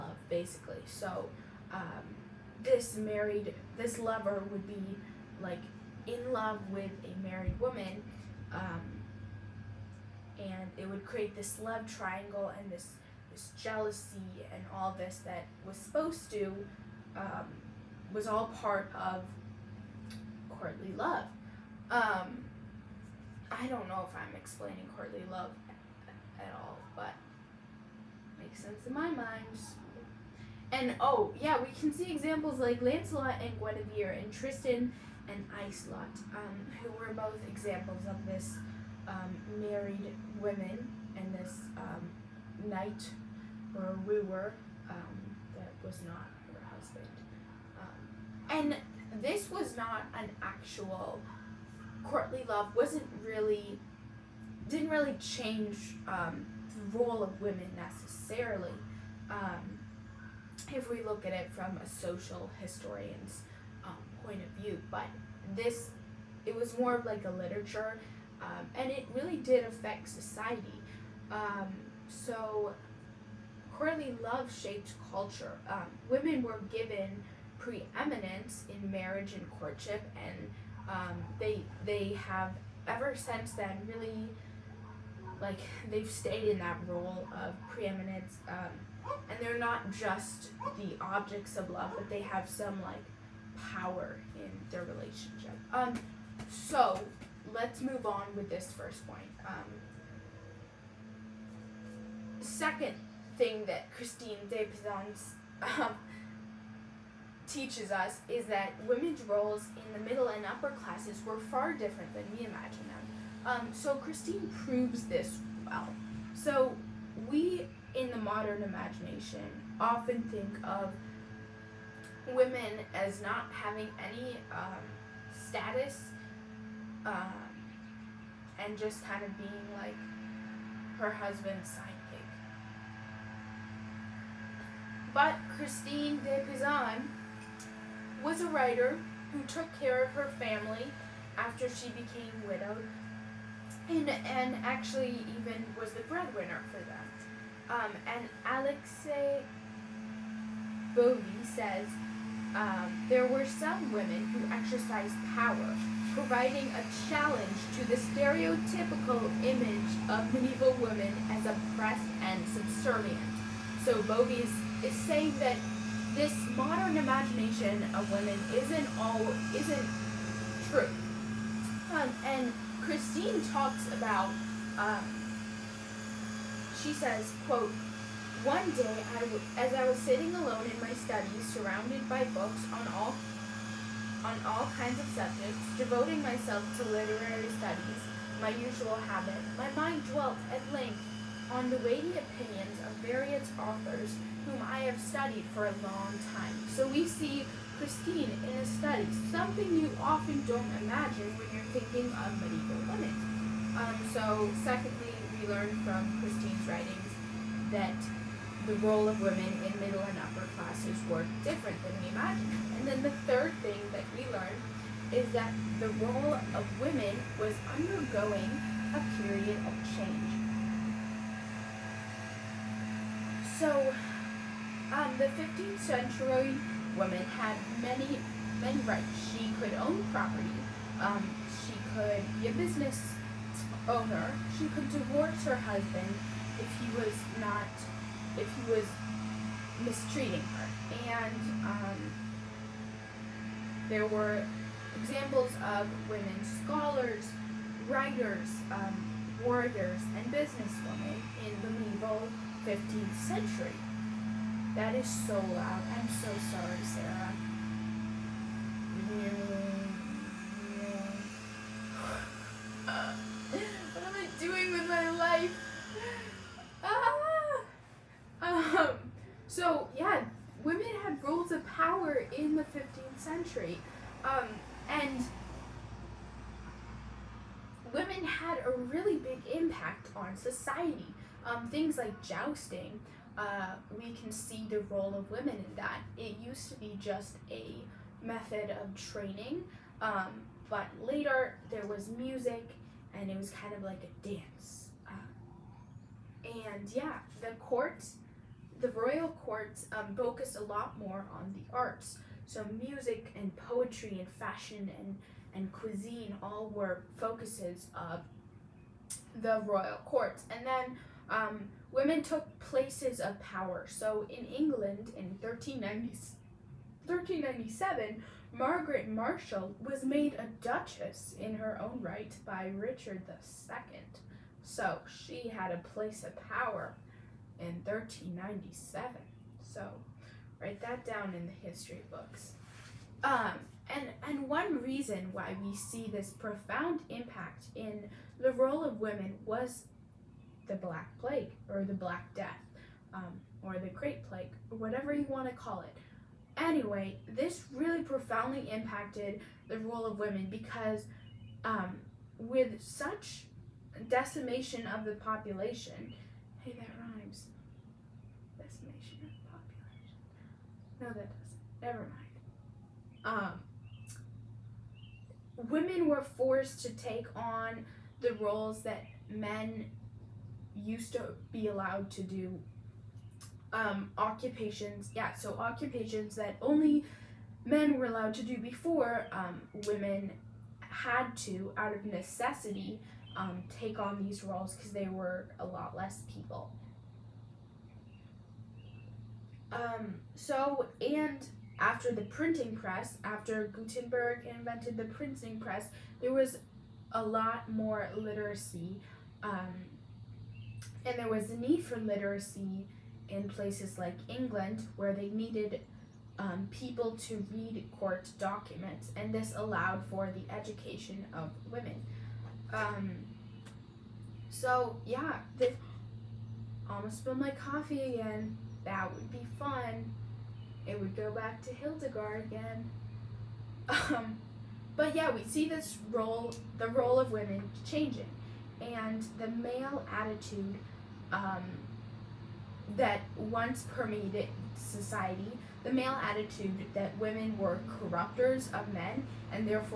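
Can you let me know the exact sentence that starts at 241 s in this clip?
And um, there were examples of women scholars, writers, um, warriors, and businesswomen in the medieval 15th century.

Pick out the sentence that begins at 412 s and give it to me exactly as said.
Um, so, yeah, this almost spilled my coffee again.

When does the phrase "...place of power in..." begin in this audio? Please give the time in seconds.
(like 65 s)
325 s.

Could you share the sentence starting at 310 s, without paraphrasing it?
And then um, Women took places of power.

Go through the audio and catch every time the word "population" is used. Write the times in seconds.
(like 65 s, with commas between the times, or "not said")
355 s, 360 s.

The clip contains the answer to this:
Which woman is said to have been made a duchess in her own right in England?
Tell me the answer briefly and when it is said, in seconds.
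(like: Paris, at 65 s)
Margaret Marshal, at 318 s.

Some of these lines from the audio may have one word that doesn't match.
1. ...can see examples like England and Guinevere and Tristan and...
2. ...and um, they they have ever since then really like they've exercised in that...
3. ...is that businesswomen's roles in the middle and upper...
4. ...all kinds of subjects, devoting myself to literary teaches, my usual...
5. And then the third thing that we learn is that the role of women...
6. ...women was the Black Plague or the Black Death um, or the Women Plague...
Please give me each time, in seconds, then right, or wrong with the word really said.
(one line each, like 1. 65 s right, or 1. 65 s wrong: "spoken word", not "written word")
1. 31 s wrong: "Lancelot", not "England"
2. 80 s wrong: "stayed", not "exercised"
3. 108 s wrong: "women", not "businesswomen"
4. 184 s wrong: "studies", not "teaches"
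5. 212 s right
6. 338 s wrong: "Great", not "Women".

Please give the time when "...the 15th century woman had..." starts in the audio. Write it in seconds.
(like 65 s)
225 s.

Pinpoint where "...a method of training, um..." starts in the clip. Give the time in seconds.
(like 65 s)
287 s.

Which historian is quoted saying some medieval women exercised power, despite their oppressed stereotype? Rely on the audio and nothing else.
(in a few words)
Alixe Bovey.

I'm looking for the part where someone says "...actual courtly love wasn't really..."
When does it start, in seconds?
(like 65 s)
50 s.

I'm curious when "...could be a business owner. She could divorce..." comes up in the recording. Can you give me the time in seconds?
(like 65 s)
231 s.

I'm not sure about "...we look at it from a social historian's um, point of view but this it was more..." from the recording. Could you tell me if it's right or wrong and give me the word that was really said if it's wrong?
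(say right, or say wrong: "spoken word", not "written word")
right.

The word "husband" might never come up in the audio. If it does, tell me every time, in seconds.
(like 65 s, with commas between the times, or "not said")
46 s, 131 s, 235 s.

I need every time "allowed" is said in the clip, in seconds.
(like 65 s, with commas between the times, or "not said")
371 s, 378 s, 409 s.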